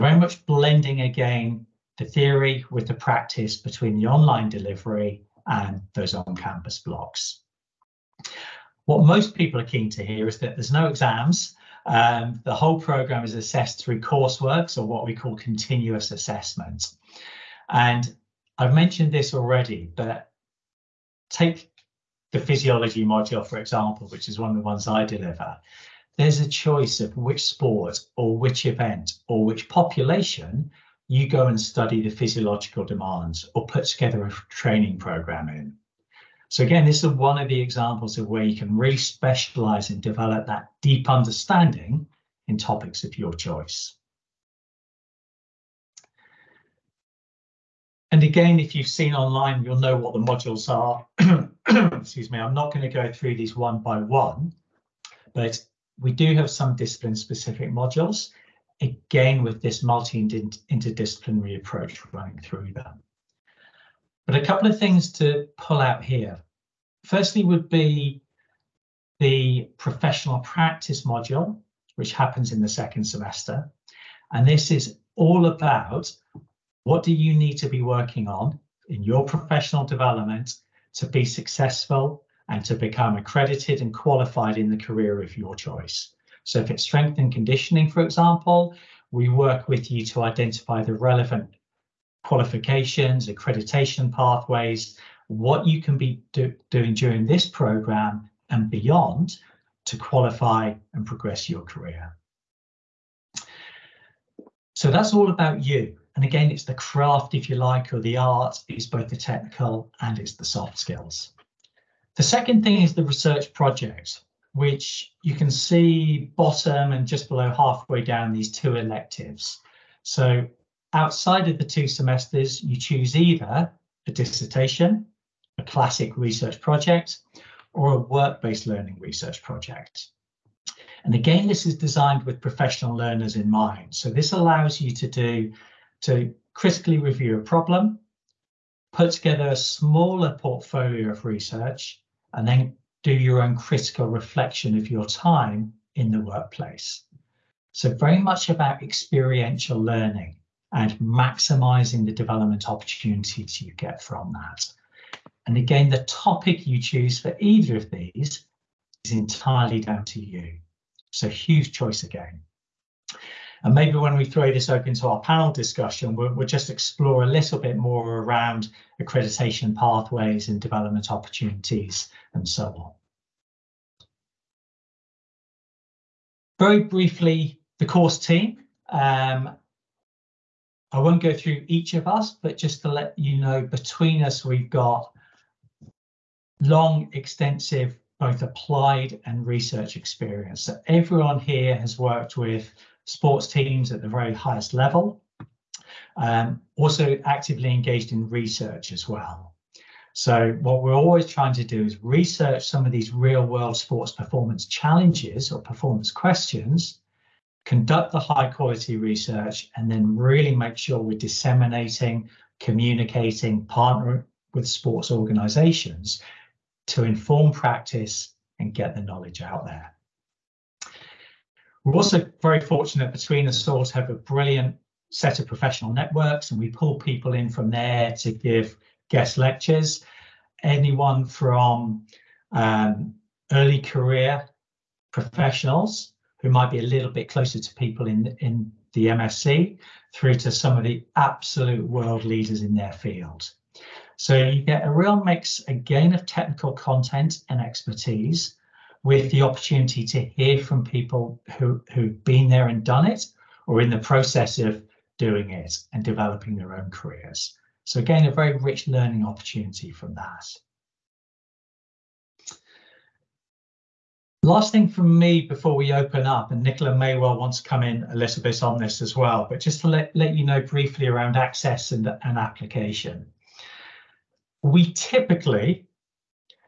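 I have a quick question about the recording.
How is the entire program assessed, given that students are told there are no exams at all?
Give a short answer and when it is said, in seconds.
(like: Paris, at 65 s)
Continuous assessment, at 15 s.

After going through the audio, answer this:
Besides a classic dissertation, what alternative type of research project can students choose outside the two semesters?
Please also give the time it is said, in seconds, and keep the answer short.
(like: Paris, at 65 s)
Work-based learning research project, at 127 s.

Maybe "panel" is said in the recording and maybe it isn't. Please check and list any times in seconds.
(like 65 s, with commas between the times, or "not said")
165 s.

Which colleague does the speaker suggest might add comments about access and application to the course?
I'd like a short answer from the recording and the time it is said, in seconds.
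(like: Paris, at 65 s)
Nicola, at 266 s.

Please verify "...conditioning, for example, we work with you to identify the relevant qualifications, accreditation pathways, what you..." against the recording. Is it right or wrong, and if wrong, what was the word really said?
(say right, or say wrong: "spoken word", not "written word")
right.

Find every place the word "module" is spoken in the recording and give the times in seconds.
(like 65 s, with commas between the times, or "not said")
23 s, 50 s, 57 s, 71 s.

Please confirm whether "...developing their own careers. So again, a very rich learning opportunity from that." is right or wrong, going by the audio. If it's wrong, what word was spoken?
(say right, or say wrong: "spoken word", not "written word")
right.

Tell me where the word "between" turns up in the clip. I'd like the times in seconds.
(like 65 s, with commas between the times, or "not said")
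3 s, 183 s, 223 s.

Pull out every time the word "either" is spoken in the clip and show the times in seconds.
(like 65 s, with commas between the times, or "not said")
123 s, 157 s.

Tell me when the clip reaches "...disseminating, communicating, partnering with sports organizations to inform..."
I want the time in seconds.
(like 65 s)
211 s.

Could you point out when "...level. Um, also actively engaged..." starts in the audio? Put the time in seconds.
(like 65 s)
194 s.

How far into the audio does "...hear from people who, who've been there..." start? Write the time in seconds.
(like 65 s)
250 s.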